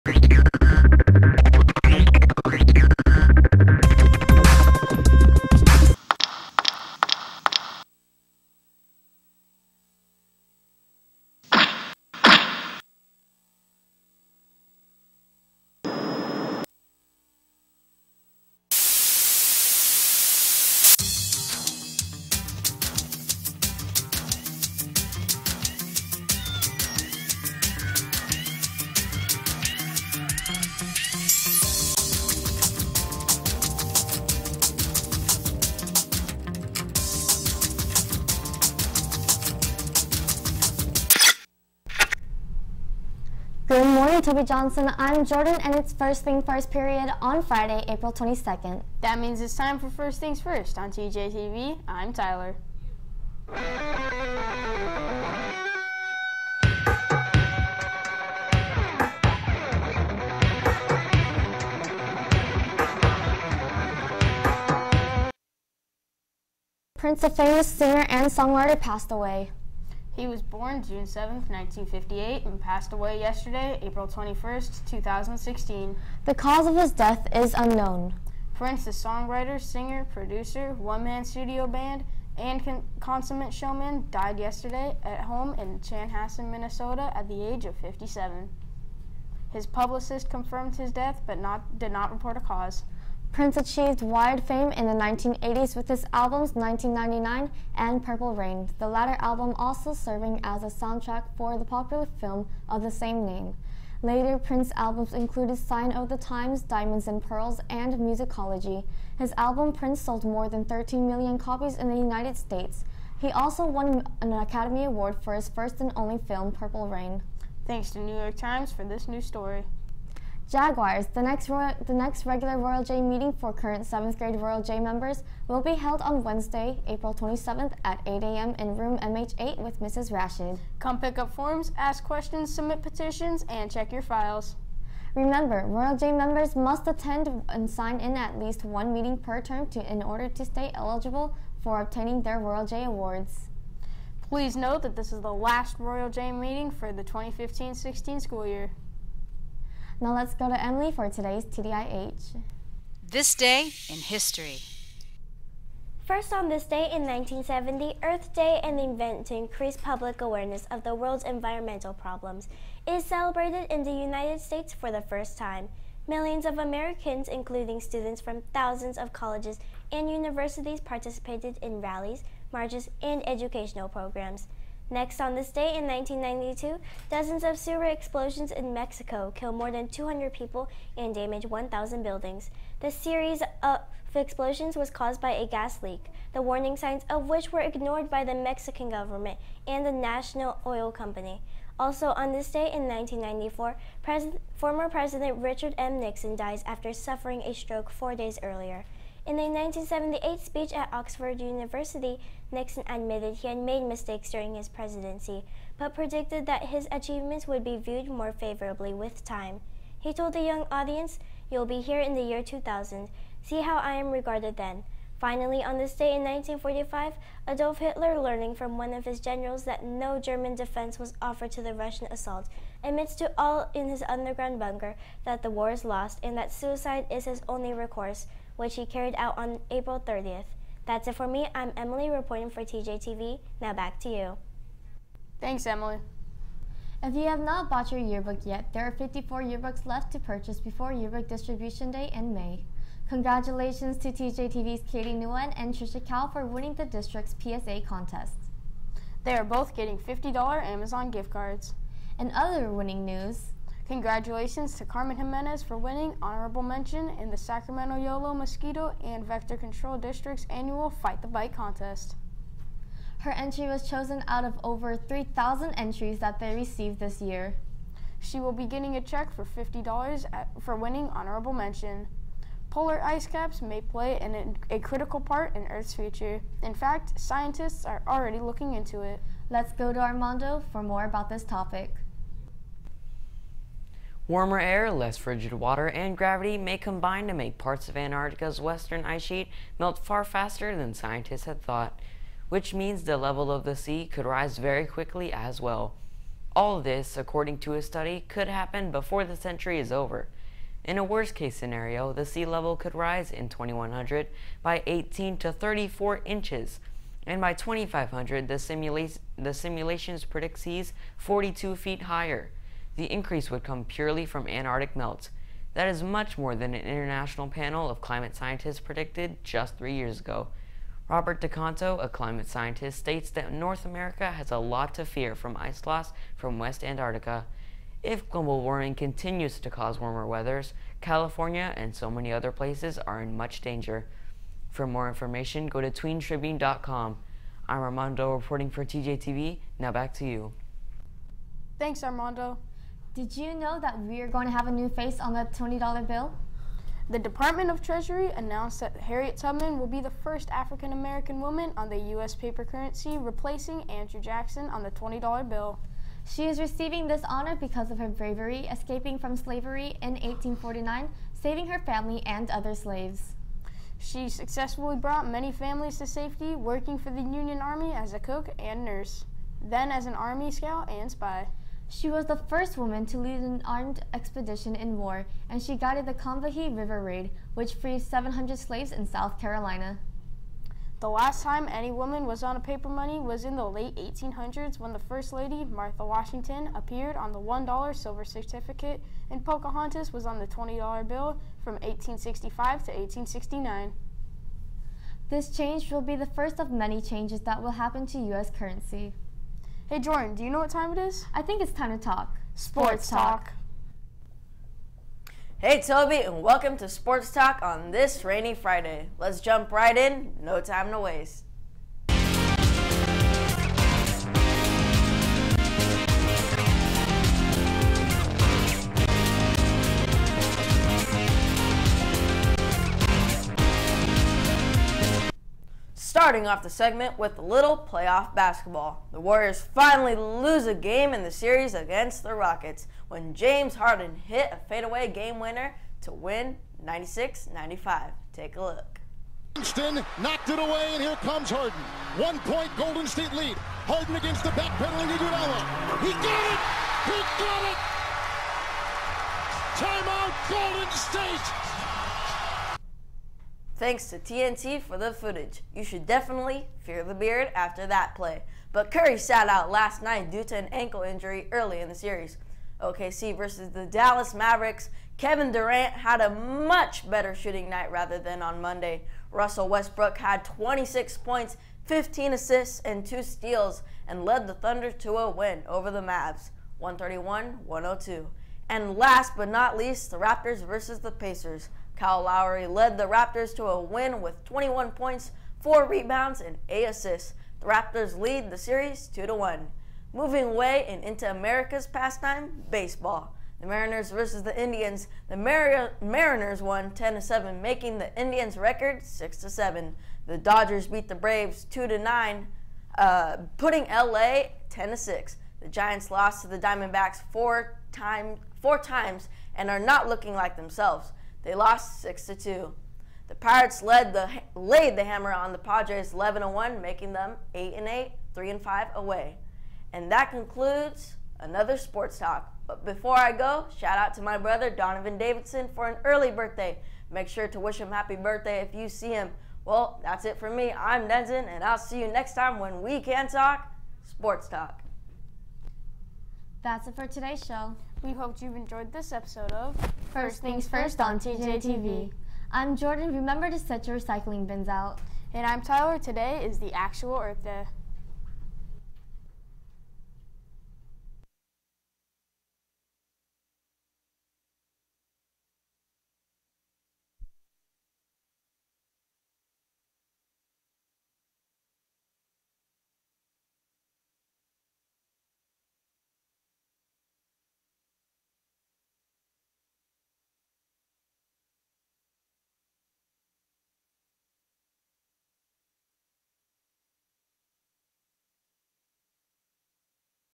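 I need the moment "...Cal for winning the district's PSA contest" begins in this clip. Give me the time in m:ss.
4:06.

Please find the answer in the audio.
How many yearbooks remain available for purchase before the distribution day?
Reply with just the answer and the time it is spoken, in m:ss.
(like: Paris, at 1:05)
54, at 3:58.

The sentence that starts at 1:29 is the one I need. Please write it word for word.
His publicist confirmed his death, but not, did not report a cause.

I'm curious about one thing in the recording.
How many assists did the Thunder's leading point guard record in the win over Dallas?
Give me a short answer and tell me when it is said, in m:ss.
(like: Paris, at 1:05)
15, at 7:51.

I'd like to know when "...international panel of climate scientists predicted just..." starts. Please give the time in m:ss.
5:16.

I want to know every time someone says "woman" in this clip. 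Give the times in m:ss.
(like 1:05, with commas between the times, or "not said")
5:51, 6:12, 6:21.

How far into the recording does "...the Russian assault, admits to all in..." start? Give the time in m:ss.
3:41.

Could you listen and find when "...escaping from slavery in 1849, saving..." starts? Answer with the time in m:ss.
5:58.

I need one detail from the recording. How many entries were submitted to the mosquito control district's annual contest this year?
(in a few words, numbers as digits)
3,000.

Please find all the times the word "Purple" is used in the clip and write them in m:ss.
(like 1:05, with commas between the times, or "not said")
1:38, 1:56.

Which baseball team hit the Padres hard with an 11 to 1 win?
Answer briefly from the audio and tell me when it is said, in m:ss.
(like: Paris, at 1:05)
Pirates, at 8:33.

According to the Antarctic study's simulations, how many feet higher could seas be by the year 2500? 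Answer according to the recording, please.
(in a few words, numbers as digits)
42 feet.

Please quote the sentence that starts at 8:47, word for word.
Make sure to wish him happy birthday if you see him.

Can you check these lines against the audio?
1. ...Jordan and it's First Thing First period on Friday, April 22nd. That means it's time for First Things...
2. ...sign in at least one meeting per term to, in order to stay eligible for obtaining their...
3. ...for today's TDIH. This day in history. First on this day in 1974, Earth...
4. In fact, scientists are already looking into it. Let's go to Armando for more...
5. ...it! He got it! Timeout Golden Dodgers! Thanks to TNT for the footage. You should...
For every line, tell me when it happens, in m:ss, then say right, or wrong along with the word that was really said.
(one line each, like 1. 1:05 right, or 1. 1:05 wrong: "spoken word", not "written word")
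1. 0:45 right
2. 2:17 right
3. 2:30 wrong: "1970", not "1974"
4. 4:36 right
5. 7:30 wrong: "State", not "Dodgers".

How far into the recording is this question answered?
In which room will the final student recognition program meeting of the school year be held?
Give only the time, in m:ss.
2:08.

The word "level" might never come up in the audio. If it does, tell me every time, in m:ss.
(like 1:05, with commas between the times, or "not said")
4:53, 5:02.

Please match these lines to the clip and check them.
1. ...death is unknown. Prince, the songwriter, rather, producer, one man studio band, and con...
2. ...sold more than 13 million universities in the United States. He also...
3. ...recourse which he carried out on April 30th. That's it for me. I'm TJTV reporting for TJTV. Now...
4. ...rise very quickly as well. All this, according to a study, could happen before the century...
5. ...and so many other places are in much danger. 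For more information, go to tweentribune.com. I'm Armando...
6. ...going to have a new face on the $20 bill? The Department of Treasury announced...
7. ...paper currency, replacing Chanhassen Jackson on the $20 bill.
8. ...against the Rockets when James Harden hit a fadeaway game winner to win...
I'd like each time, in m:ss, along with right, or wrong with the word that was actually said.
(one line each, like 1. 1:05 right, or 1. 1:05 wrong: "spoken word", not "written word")
1. 1:16 wrong: "singer", not "rather"
2. 1:50 wrong: "copies", not "universities"
3. 3:47 wrong: "Emily", not "TJTV"
4. 4:54 right
5. 5:31 right
6. 5:44 right
7. 5:52 wrong: "Andrew", not "Chanhassen"
8. 7:11 right.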